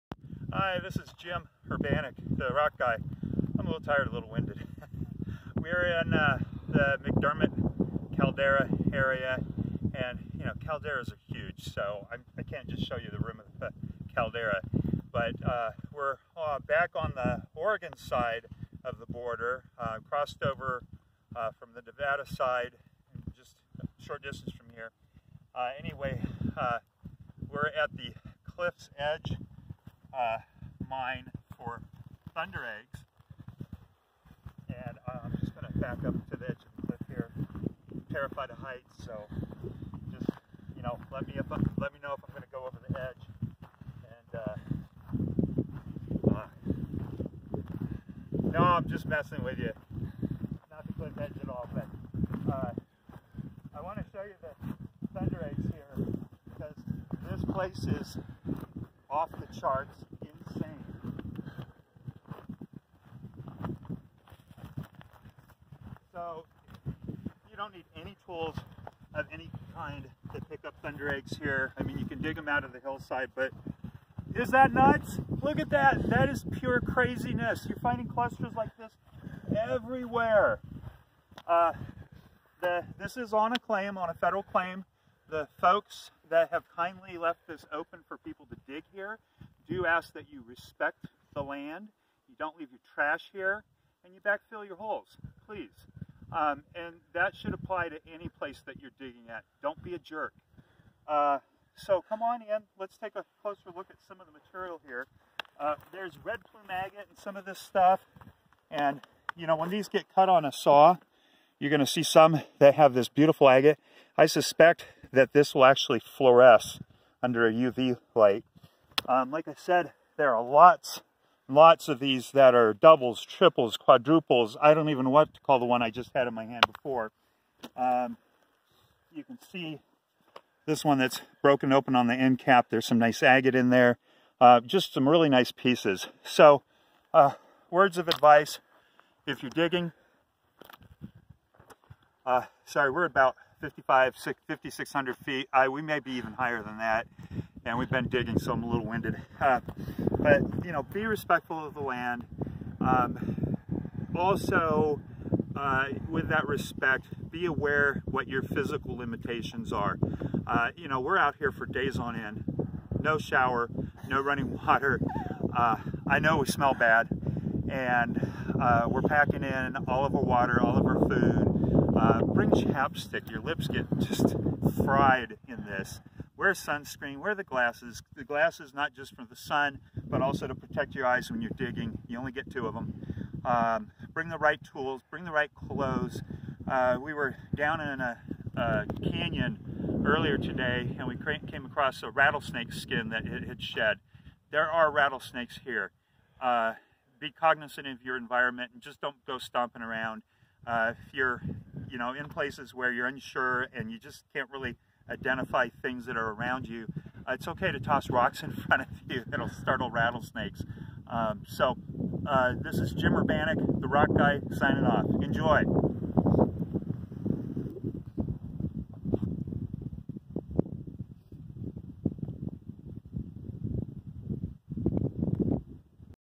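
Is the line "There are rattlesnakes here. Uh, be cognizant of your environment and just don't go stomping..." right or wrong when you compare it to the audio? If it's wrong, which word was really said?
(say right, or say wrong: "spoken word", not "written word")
right.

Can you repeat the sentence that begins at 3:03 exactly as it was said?
Um, bring the right tools, bring the right clothes.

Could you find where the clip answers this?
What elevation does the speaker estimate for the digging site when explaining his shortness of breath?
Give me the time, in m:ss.
2:24.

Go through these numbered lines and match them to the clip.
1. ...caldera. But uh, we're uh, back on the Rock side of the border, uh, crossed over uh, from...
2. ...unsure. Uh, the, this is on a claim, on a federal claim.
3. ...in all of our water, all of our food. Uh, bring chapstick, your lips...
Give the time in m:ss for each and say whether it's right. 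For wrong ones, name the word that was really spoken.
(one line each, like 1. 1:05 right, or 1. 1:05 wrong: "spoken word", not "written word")
1. 0:14 wrong: "Oregon", not "Rock"
2. 1:19 wrong: "everywhere", not "unsure"
3. 2:49 right.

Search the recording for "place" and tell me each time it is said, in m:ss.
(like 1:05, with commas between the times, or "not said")
0:57, 1:38, 3:22.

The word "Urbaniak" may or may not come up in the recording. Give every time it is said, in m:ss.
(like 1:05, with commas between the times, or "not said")
0:01, 3:33.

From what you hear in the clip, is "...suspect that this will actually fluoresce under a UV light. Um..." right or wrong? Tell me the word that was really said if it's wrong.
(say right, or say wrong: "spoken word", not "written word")
right.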